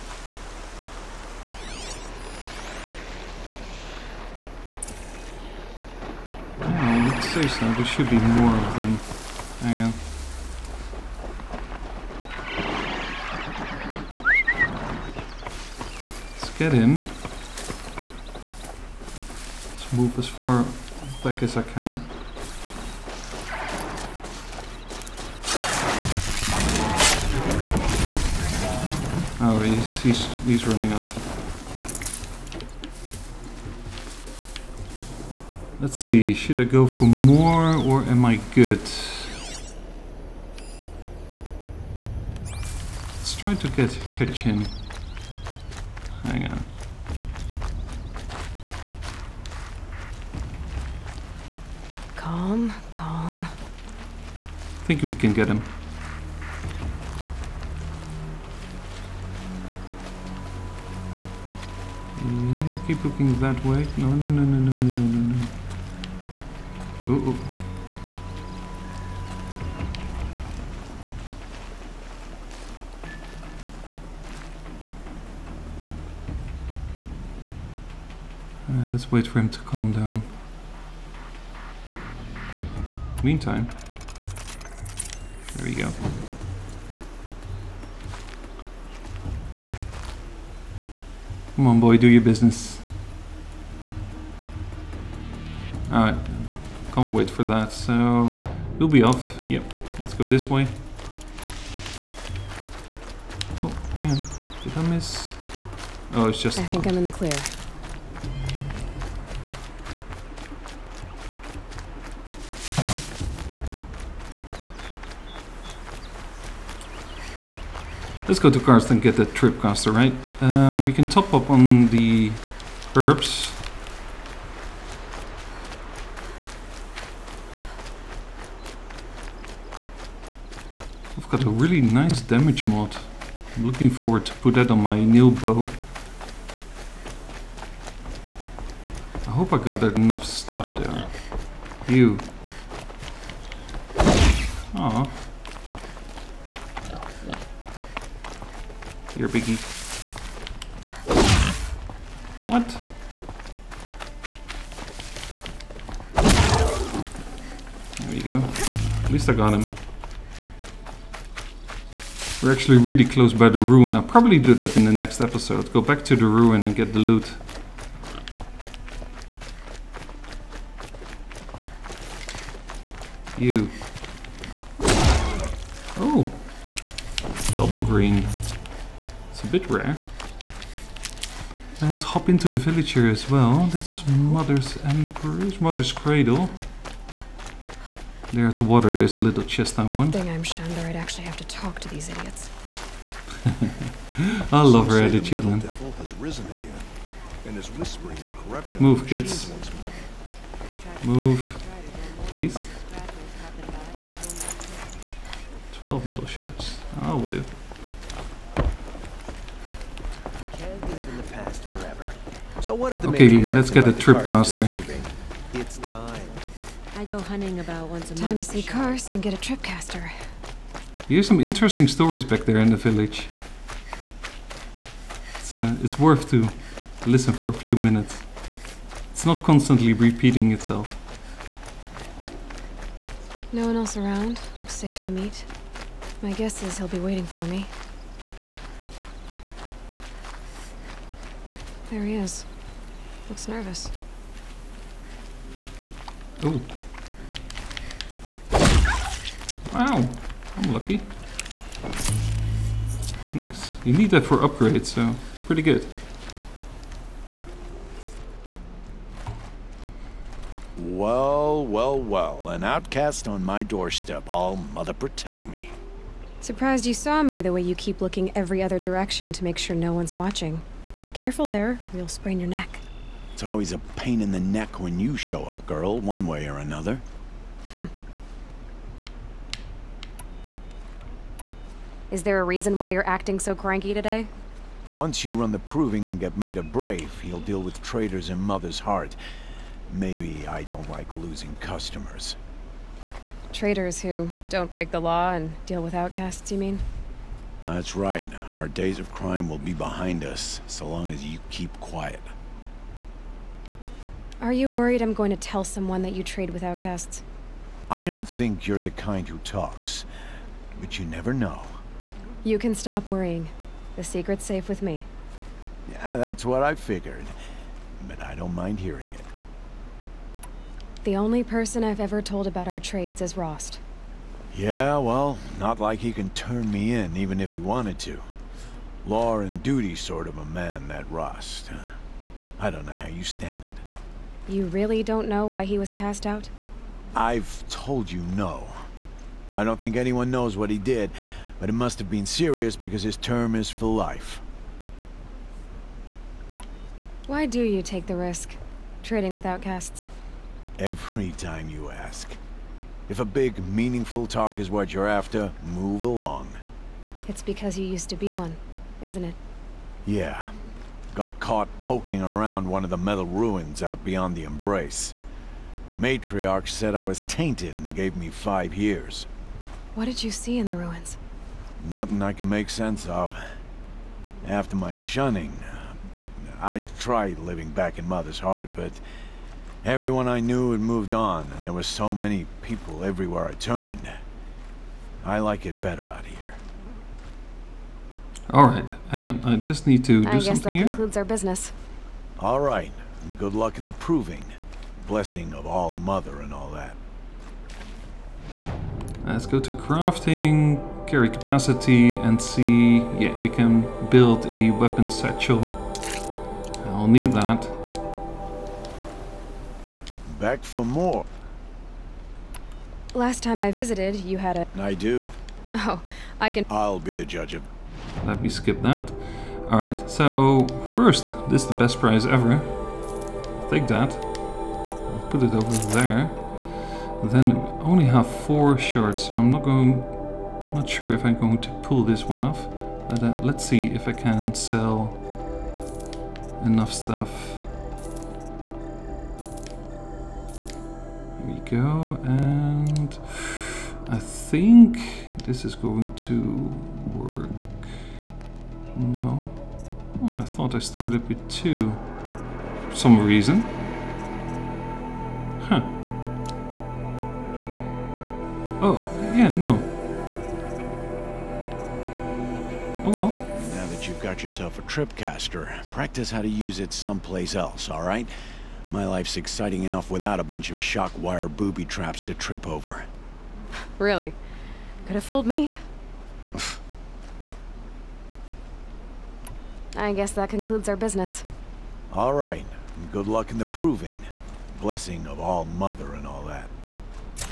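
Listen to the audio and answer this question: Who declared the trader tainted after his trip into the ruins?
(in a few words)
Matriarch.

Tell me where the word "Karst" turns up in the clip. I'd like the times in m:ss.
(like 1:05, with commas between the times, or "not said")
1:58, 3:38.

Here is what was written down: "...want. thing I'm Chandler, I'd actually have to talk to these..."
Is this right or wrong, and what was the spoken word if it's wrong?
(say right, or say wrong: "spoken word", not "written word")
right.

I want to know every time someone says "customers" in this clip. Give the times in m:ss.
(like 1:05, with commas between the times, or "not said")
4:51.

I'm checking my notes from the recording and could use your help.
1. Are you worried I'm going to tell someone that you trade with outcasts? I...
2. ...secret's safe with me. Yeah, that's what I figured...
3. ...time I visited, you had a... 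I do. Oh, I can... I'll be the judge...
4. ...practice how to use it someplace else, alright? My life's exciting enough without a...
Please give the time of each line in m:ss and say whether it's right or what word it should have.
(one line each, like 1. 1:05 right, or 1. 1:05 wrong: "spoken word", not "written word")
1. 5:04 right
2. 5:14 right
3. 6:53 right
4. 7:45 right.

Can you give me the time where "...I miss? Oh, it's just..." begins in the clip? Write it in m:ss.
1:44.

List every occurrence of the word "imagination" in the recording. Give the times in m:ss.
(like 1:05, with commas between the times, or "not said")
not said.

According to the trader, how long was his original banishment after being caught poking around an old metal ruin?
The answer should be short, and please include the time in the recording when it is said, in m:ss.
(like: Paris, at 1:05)
5 years, at 6:08.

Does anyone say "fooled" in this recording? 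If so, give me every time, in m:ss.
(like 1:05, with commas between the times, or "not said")
7:55.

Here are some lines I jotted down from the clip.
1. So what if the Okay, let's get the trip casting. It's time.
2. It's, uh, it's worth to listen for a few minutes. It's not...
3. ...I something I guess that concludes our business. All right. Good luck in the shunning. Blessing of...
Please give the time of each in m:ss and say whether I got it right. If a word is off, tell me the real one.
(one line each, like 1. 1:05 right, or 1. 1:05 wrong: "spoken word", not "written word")
1. 3:32 right
2. 3:45 right
3. 6:30 wrong: "proving", not "shunning".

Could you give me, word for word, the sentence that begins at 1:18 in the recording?
Uh, let's wait for him to calm down.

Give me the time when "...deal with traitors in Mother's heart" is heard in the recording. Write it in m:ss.
4:47.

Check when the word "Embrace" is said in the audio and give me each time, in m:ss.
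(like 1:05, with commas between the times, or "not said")
3:04, 6:04.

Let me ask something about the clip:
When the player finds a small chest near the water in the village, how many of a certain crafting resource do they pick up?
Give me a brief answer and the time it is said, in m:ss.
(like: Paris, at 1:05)
12, at 3:25.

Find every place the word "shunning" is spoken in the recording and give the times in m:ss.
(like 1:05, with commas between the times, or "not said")
6:14.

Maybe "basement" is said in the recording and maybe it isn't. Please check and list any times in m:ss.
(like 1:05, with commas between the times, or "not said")
not said.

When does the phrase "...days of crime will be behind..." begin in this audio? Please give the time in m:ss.
4:58.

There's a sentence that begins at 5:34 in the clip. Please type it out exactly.
You really don't know why he was cast out?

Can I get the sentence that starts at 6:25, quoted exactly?
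I like it better out here.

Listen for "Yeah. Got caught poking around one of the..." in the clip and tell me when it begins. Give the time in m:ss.
6:00.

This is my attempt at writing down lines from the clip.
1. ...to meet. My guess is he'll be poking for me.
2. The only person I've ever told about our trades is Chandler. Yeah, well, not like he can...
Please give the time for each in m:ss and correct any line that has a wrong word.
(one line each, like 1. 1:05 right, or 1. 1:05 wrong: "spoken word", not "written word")
1. 3:55 wrong: "waiting", not "poking"
2. 5:21 wrong: "Rost", not "Chandler".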